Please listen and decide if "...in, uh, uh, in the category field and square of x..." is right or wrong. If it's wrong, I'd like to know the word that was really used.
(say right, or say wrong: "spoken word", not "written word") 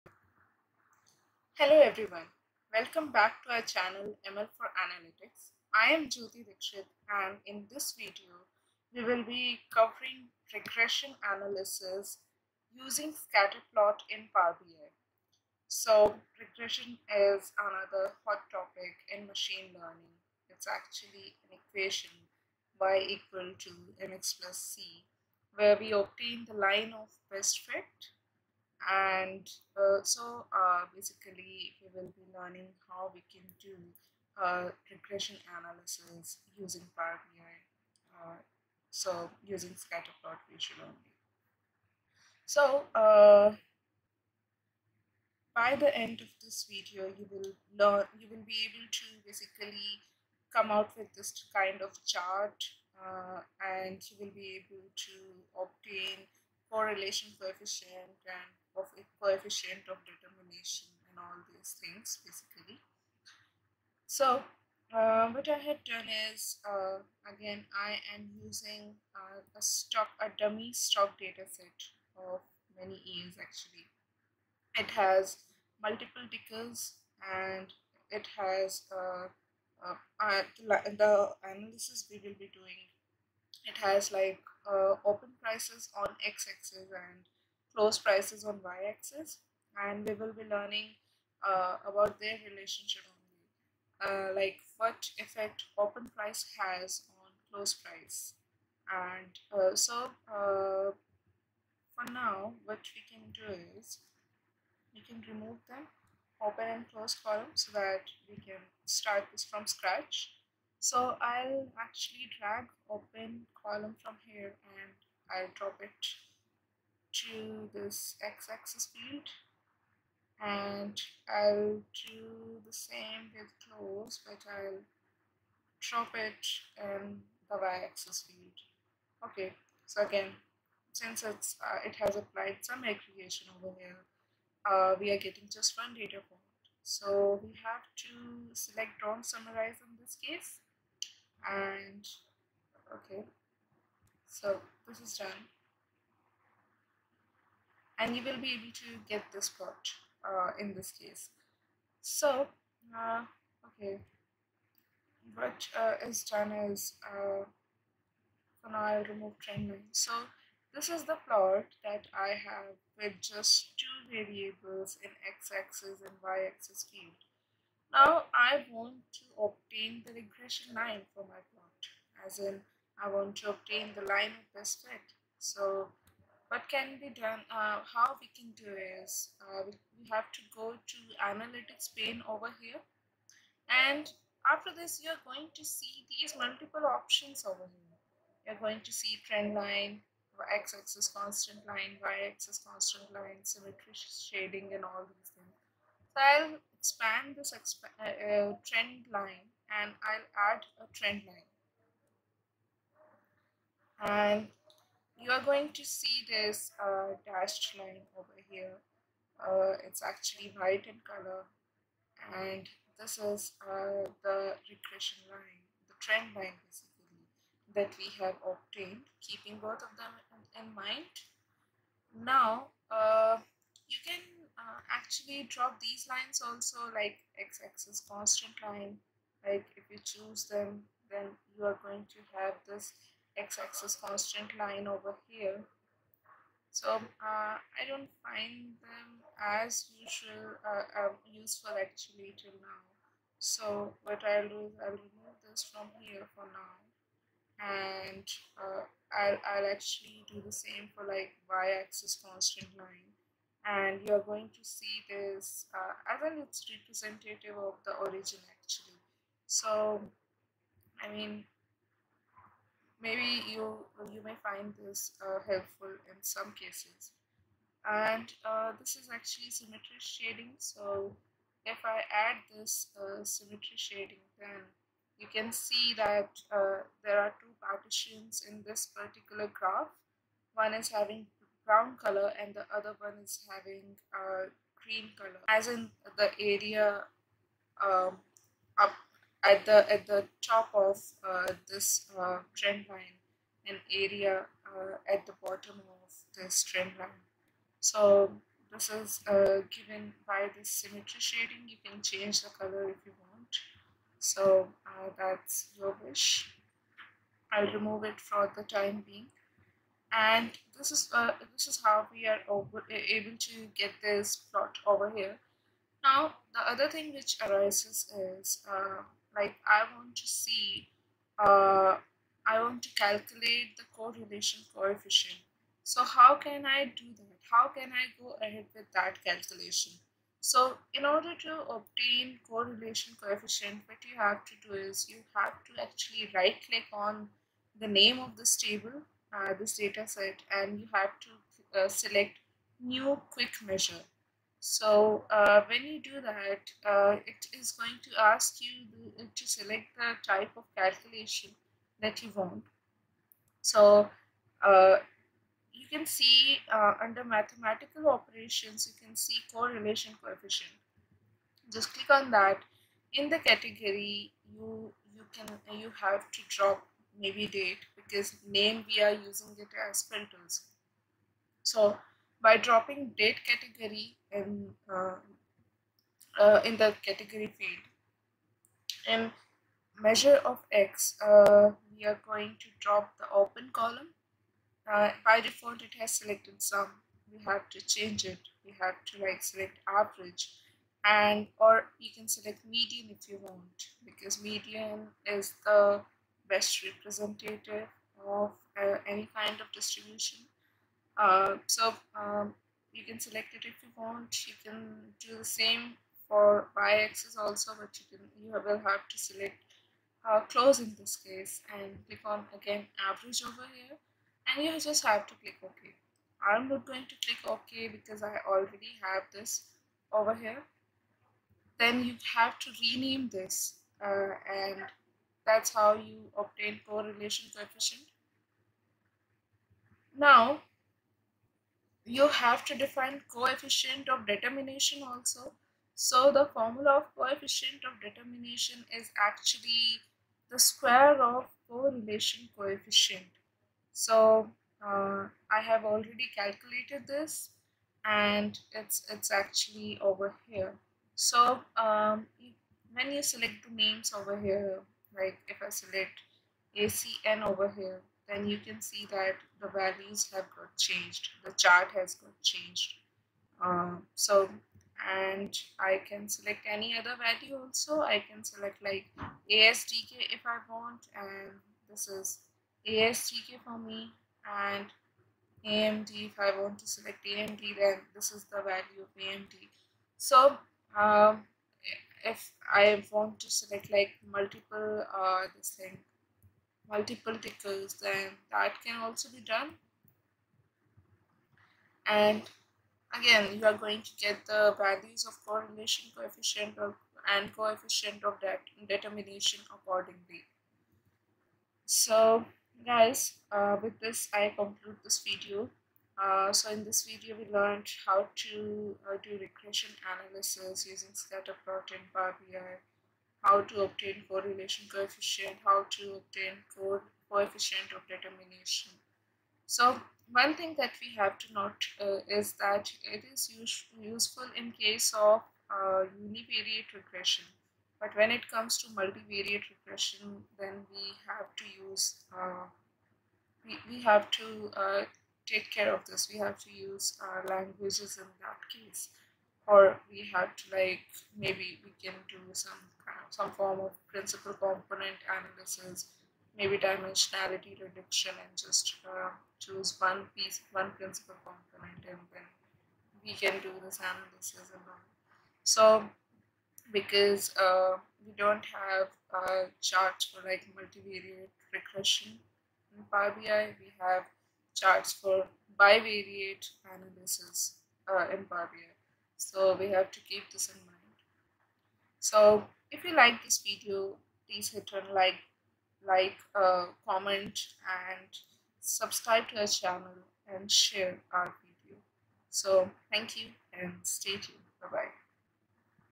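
wrong: "measure", not "square".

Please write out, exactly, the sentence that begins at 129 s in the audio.
Okay, so again, since it's uh, it has applied some aggregation over here, uh, we are getting just one data point.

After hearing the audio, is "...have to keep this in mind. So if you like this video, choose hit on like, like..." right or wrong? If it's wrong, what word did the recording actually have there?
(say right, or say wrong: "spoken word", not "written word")
wrong: "please", not "choose".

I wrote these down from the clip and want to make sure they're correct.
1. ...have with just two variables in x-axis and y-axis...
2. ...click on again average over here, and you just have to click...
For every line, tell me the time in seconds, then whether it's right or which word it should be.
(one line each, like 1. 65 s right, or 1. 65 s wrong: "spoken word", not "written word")
1. 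162 s right
2. 412 s right.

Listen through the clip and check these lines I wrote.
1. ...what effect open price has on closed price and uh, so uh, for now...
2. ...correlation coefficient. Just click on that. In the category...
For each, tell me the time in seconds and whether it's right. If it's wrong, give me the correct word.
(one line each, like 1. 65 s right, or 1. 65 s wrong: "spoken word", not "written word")
1. 94 s right
2. 359 s right.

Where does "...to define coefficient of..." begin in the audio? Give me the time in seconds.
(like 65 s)
432 s.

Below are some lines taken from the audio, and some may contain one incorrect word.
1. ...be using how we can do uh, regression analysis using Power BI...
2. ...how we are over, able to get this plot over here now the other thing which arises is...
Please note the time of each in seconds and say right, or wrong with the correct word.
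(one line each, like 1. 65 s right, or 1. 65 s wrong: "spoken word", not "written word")
1. 32 s wrong: "learning", not "using"
2. 311 s right.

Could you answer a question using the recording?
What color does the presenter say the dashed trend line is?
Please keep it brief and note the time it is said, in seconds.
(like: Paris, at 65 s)
White, at 210 s.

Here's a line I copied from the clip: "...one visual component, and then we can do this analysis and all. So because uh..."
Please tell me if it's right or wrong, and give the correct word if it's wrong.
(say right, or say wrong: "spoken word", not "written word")
wrong: "principal", not "visual".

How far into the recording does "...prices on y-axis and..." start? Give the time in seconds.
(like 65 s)
88 s.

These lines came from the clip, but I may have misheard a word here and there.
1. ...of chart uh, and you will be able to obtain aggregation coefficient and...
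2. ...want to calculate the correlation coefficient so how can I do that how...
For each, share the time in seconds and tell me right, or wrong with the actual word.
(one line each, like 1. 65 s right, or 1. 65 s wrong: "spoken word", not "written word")
1. 51 s wrong: "correlation", not "aggregation"
2. 322 s right.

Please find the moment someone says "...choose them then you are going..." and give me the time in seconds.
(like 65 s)
230 s.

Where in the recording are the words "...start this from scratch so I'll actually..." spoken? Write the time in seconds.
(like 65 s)
108 s.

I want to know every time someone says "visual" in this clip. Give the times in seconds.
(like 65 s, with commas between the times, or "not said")
40 s.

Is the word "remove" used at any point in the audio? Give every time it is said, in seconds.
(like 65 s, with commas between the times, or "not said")
105 s, 159 s, 244 s, 307 s.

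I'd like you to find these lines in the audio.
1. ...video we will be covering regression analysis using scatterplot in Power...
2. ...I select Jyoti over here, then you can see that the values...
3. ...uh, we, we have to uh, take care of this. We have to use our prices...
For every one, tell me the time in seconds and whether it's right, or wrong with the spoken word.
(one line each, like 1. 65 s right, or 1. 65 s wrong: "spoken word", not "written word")
1. 7 s right
2. 455 s wrong: "ACN", not "Jyoti"
3. 532 s wrong: "languages", not "prices".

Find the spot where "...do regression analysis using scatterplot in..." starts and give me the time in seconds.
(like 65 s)
509 s.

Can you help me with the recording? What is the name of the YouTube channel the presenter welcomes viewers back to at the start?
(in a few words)
ML for Analytics.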